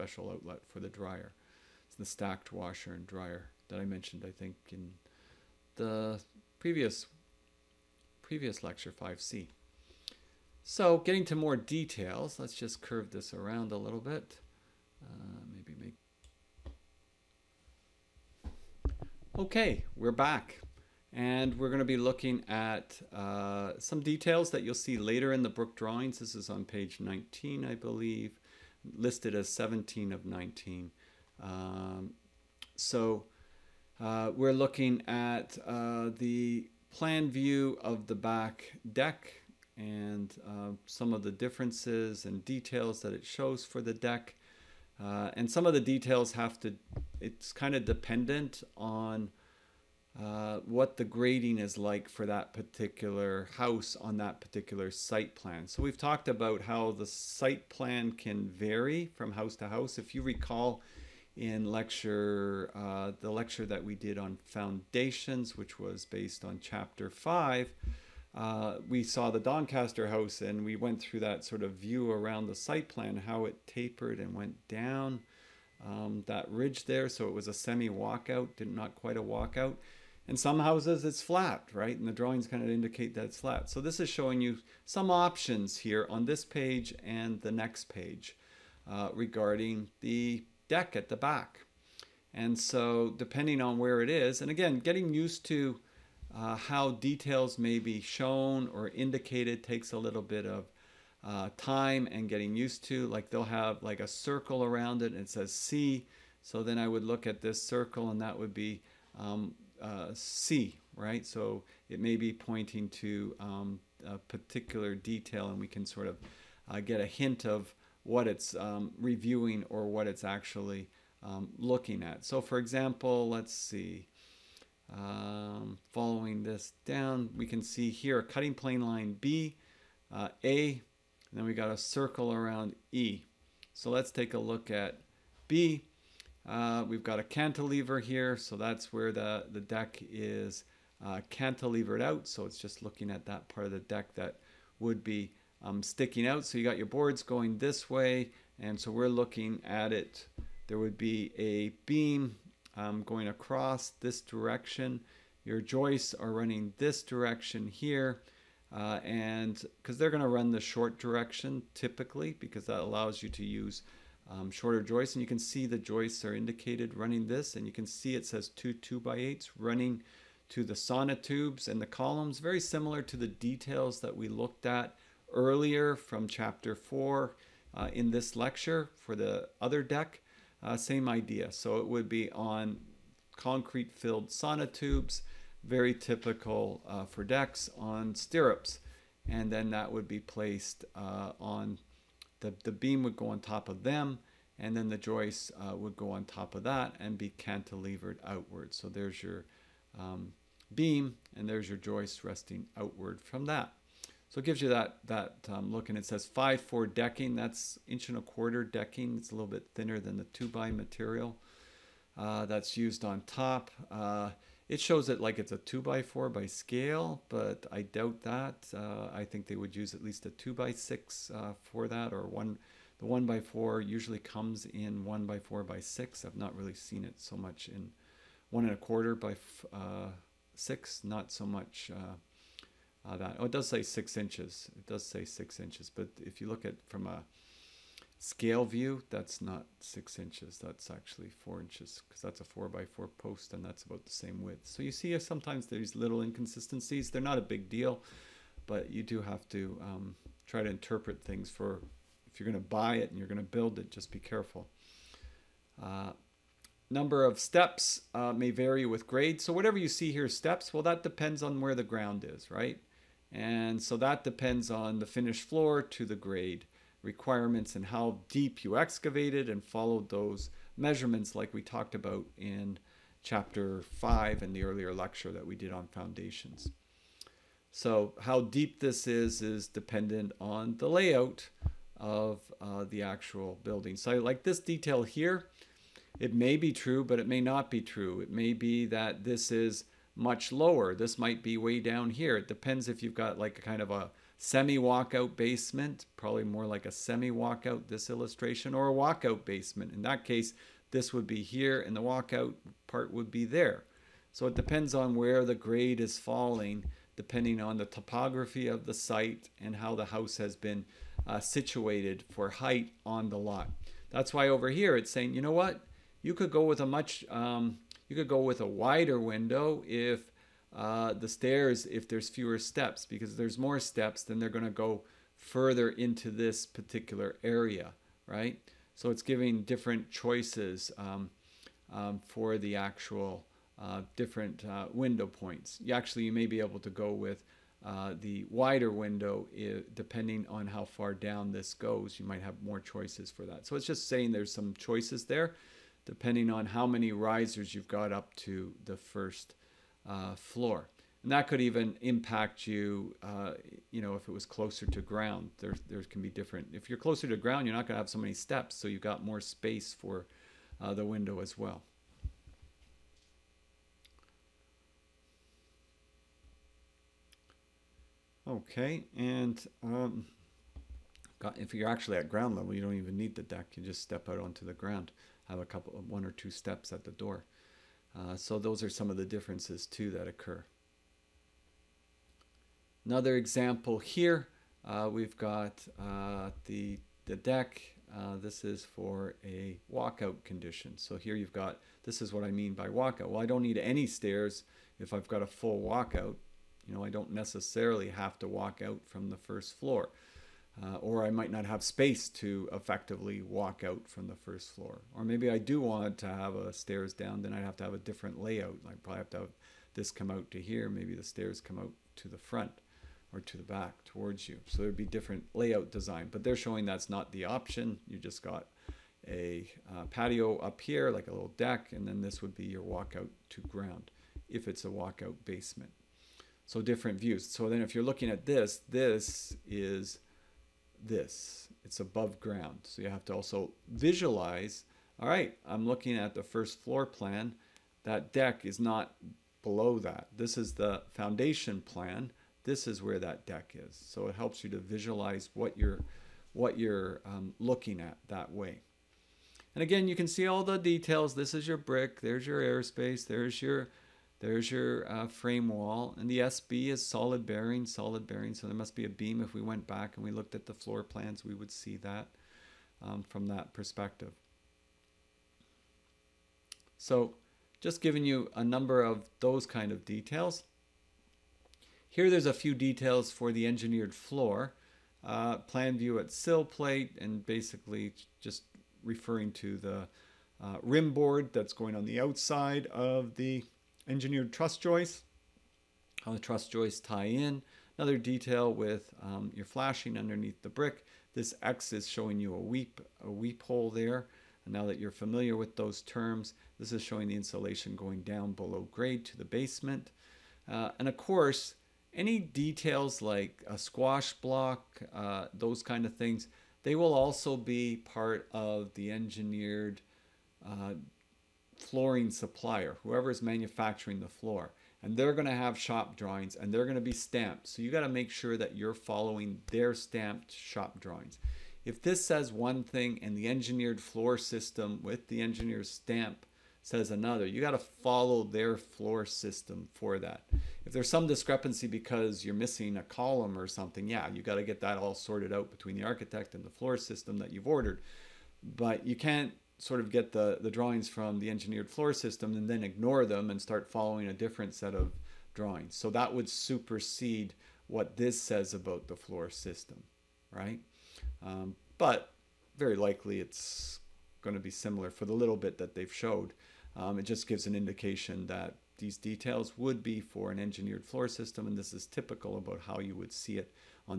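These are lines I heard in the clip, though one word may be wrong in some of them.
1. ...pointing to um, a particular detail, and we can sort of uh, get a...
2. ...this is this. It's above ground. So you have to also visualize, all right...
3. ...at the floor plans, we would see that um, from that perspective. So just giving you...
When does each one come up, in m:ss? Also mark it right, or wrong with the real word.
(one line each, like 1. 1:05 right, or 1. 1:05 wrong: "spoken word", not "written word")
1. 1:52 right
2. 7:08 right
3. 7:40 right.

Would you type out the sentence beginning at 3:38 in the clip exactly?
Uh, I think they would use at least a 2 by 6 uh, for that, or one.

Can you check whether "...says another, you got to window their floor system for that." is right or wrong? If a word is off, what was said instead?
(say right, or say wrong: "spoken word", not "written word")
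wrong: "follow", not "window".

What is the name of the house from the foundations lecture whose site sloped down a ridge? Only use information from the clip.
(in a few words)
Doncaster.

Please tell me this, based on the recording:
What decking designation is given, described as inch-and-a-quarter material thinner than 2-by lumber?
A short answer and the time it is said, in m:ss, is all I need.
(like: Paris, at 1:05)
5-4 decking, at 3:26.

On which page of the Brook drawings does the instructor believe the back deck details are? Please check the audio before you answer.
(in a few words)
page 19.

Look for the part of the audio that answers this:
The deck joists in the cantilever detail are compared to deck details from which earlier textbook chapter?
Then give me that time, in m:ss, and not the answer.
2:56.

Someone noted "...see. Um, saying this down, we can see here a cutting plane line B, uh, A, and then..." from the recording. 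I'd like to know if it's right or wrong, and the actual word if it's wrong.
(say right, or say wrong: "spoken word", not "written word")
wrong: "following", not "saying".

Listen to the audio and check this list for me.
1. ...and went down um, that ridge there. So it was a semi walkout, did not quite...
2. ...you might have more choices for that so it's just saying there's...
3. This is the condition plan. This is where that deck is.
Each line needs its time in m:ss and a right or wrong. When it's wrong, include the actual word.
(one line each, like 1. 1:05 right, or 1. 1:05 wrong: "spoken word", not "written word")
1. 1:14 right
2. 5:42 right
3. 7:20 wrong: "foundation", not "condition".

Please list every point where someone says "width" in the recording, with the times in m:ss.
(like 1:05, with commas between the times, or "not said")
4:04.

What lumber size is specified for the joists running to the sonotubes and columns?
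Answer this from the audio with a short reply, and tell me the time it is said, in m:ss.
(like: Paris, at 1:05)
2 by 8s, at 2:48.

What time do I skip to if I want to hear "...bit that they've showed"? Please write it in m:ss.
9:15.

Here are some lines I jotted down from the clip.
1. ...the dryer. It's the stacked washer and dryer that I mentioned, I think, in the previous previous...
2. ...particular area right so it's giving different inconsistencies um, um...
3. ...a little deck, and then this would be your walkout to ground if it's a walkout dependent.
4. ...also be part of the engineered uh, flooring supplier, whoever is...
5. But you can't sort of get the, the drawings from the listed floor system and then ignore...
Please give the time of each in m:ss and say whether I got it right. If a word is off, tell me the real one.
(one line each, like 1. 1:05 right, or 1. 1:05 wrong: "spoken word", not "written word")
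1. 0:00 right
2. 5:26 wrong: "choices", not "inconsistencies"
3. 7:01 wrong: "basement", not "dependent"
4. 8:27 right
5. 8:58 wrong: "engineered", not "listed".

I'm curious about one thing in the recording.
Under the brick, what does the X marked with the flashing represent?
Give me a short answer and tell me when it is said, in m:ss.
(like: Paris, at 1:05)
weep hole, at 8:13.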